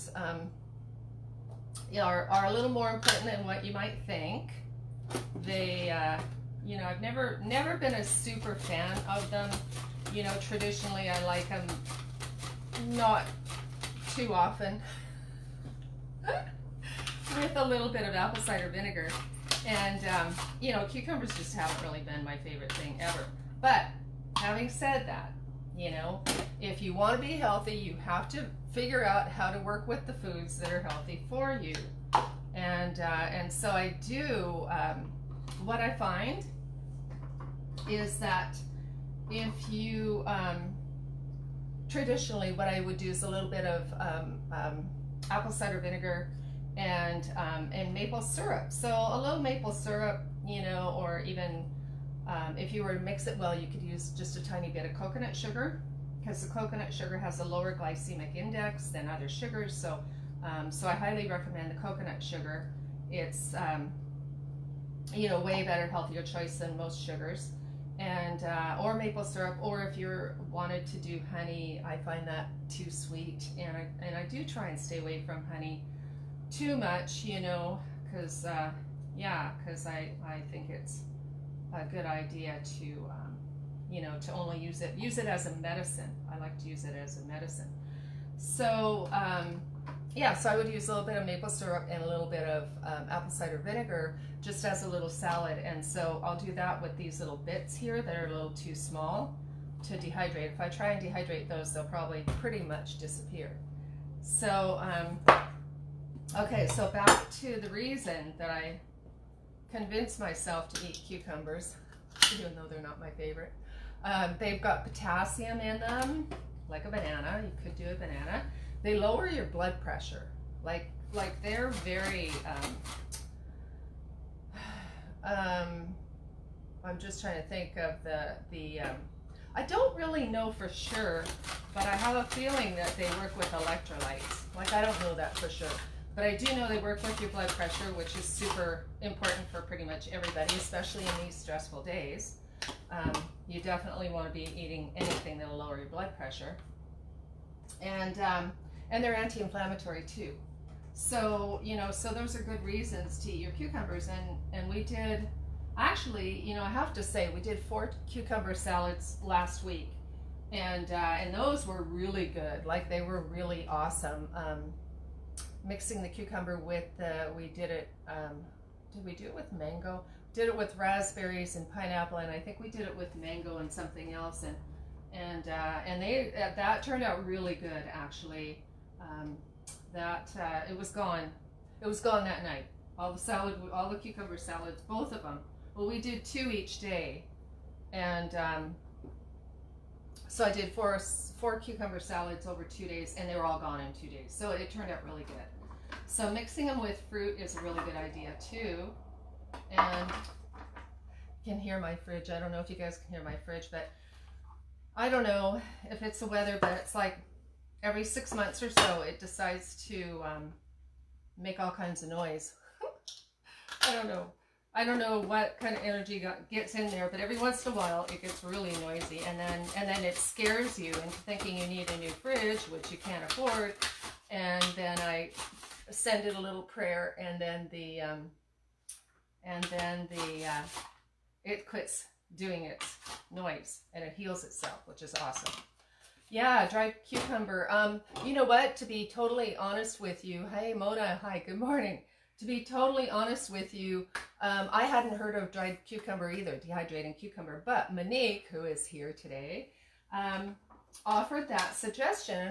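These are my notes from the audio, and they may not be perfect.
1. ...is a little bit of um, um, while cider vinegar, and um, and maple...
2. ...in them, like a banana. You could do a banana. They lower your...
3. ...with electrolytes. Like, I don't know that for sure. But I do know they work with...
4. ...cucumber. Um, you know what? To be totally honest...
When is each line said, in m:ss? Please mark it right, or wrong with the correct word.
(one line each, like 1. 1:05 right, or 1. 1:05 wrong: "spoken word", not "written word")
1. 0:43 wrong: "apple", not "while"
2. 1:55 right
3. 2:13 right
4. 3:57 right.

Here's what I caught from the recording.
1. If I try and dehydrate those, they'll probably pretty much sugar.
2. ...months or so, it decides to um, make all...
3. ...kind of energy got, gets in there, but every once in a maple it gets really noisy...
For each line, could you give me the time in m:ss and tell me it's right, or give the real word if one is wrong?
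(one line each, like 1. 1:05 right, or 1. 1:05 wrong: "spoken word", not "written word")
1. 1:40 wrong: "disappear", not "sugar"
2. 3:28 right
3. 3:35 wrong: "while", not "maple".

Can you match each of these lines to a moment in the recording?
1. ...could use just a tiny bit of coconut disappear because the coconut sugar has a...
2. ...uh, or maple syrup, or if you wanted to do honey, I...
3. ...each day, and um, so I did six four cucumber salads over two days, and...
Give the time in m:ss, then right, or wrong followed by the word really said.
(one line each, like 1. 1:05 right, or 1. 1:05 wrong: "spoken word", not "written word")
1. 0:53 wrong: "sugar", not "disappear"
2. 1:08 right
3. 3:06 wrong: "four", not "six".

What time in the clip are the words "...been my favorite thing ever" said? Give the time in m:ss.
0:21.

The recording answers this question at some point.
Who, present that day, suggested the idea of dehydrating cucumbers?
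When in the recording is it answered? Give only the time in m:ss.
4:07.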